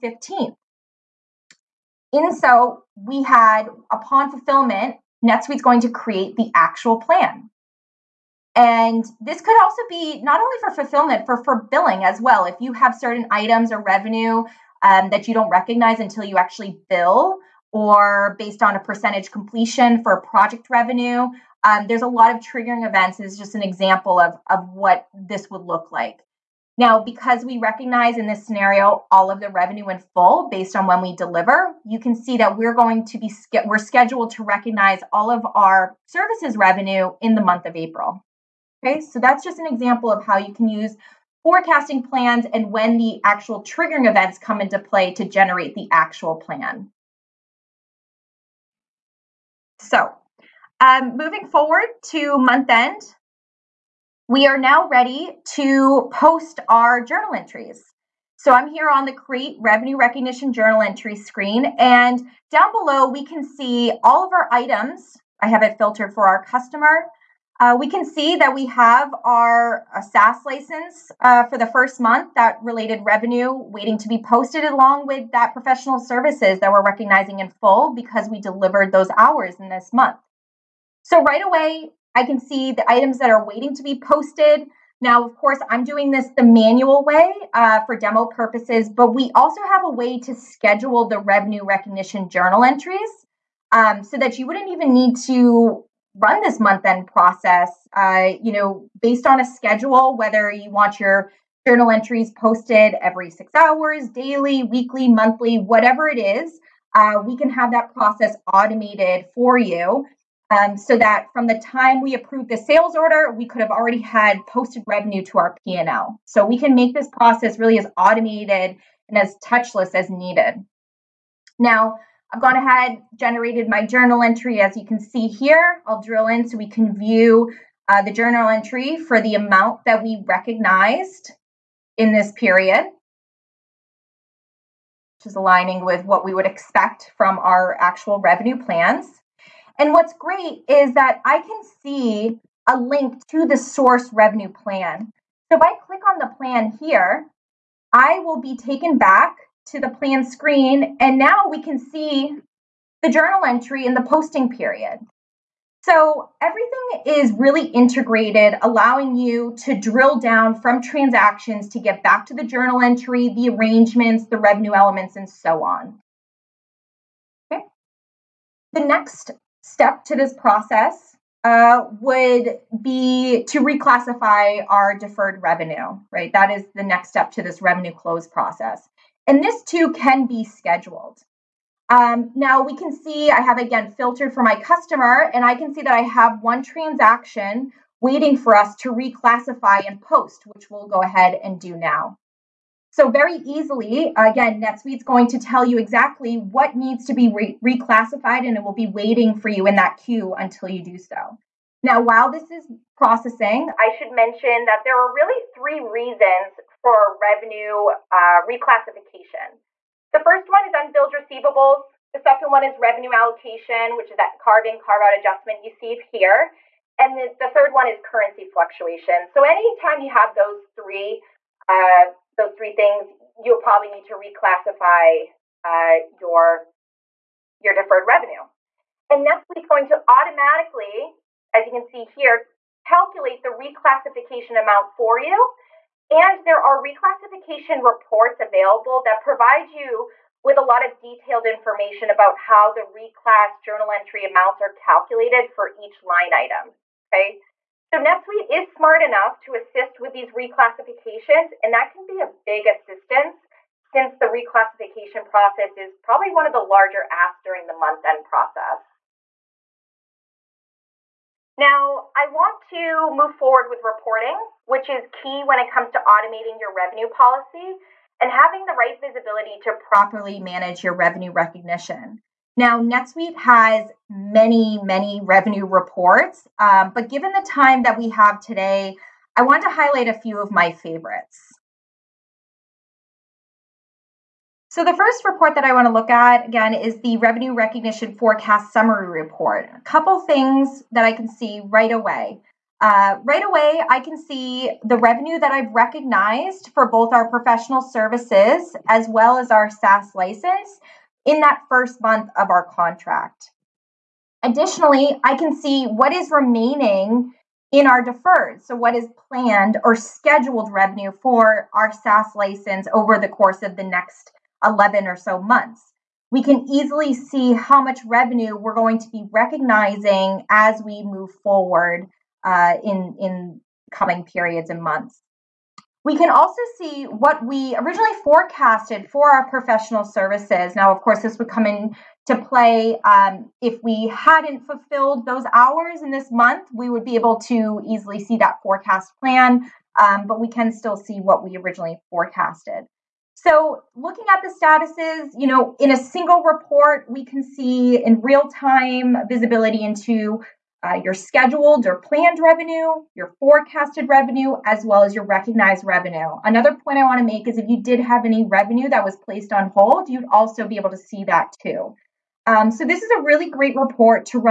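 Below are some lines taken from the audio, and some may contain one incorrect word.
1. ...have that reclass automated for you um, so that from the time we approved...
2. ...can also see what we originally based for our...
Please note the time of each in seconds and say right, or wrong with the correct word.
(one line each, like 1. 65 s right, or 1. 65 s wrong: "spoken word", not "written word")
1. 107 s wrong: "process", not "reclass"
2. 326 s wrong: "forecasted", not "based".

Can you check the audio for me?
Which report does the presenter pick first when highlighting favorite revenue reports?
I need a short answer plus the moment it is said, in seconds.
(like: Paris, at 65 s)
Revenue Recognition Forecast Summary Report, at 287 s.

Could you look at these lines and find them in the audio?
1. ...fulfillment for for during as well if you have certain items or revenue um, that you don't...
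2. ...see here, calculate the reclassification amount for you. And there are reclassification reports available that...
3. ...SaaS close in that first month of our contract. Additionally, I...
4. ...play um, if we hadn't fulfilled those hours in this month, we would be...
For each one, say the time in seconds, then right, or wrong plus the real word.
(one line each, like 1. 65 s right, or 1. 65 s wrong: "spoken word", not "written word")
1. 10 s wrong: "billing", not "during"
2. 231 s right
3. 299 s wrong: "license", not "close"
4. 332 s right.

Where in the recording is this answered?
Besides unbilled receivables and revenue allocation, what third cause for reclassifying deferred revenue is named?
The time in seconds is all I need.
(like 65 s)
218 s.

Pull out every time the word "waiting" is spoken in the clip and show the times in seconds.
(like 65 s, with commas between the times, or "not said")
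73 s, 83 s, 188 s, 198 s.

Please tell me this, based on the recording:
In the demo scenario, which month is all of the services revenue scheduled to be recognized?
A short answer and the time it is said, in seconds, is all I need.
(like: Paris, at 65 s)
April, at 37 s.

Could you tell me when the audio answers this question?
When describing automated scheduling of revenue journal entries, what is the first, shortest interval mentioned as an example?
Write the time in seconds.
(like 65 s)
103 s.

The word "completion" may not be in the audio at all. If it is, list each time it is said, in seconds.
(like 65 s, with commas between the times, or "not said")
19 s.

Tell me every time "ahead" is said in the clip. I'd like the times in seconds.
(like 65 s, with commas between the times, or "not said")
122 s, 191 s.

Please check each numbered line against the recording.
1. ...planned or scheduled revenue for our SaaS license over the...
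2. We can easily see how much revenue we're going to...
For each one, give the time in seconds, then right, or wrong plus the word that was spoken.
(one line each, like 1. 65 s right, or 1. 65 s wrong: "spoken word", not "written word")
1. 309 s right
2. 316 s right.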